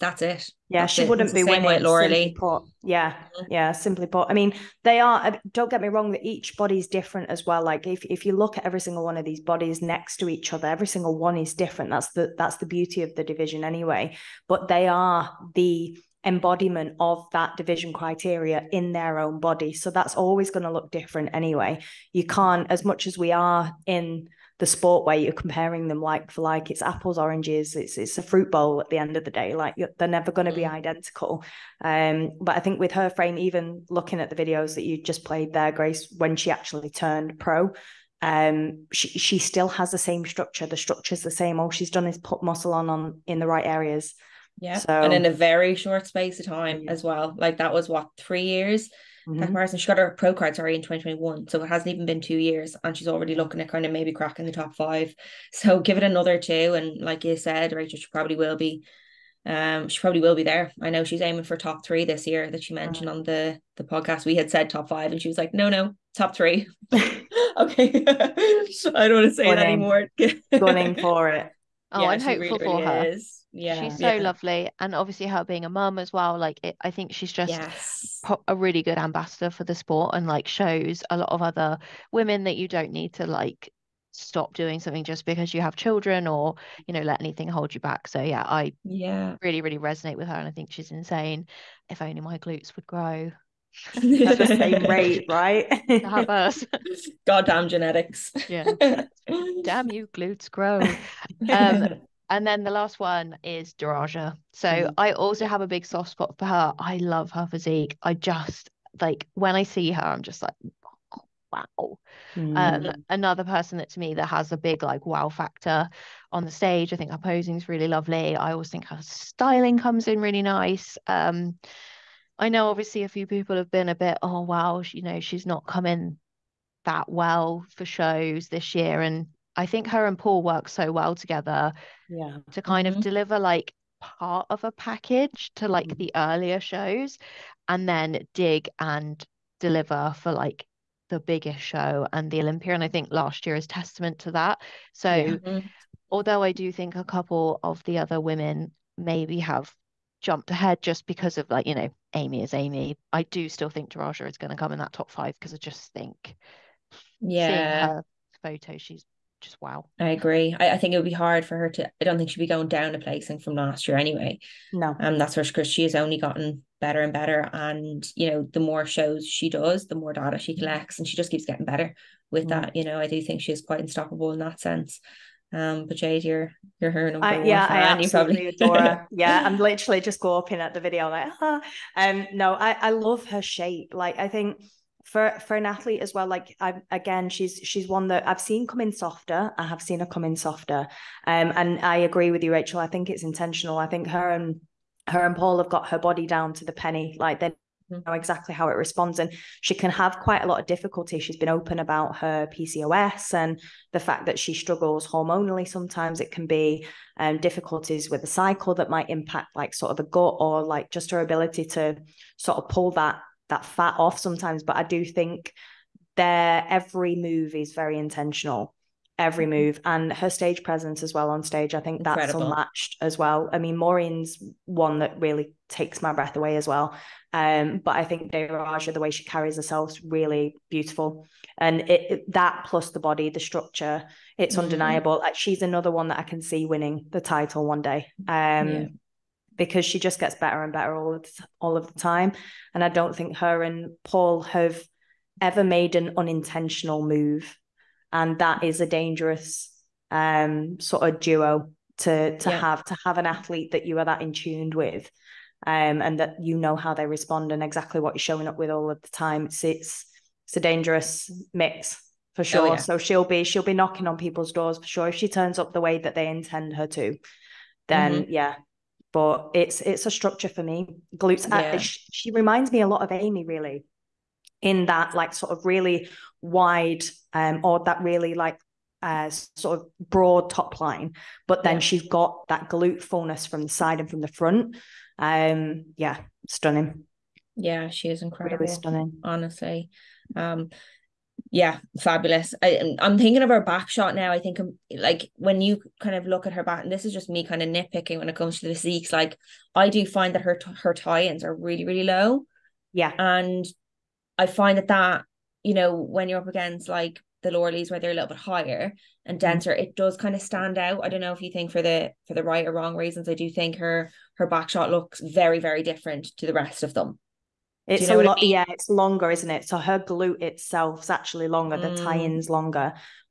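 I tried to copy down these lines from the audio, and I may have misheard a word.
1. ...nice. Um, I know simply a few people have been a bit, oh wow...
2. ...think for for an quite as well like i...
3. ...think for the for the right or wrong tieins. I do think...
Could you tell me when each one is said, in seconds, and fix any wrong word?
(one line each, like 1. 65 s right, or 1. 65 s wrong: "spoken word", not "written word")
1. 120 s wrong: "obviously", not "simply"
2. 184 s wrong: "athlete", not "quite"
3. 311 s wrong: "reasons", not "tieins".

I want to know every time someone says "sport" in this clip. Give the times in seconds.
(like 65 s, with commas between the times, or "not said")
24 s, 79 s.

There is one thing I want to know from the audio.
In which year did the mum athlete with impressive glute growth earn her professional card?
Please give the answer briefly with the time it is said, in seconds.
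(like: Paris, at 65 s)
2021, at 50 s.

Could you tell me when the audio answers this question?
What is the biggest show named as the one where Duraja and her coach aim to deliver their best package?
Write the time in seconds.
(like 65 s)
142 s.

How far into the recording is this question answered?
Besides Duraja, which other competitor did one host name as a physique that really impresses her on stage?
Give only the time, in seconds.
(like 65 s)
223 s.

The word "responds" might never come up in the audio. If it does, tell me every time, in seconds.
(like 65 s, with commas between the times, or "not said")
198 s, 257 s.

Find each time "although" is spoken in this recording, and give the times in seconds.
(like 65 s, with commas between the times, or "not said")
146 s.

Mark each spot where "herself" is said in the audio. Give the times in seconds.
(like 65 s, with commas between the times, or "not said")
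229 s.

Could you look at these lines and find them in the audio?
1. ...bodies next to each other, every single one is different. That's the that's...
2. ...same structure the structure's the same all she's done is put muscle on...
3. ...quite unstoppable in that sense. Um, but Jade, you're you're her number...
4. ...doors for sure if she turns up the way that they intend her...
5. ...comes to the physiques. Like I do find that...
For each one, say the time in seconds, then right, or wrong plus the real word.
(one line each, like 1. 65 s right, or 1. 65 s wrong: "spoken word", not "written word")
1. 9 s right
2. 39 s right
3. 173 s right
4. 264 s right
5. 298 s right.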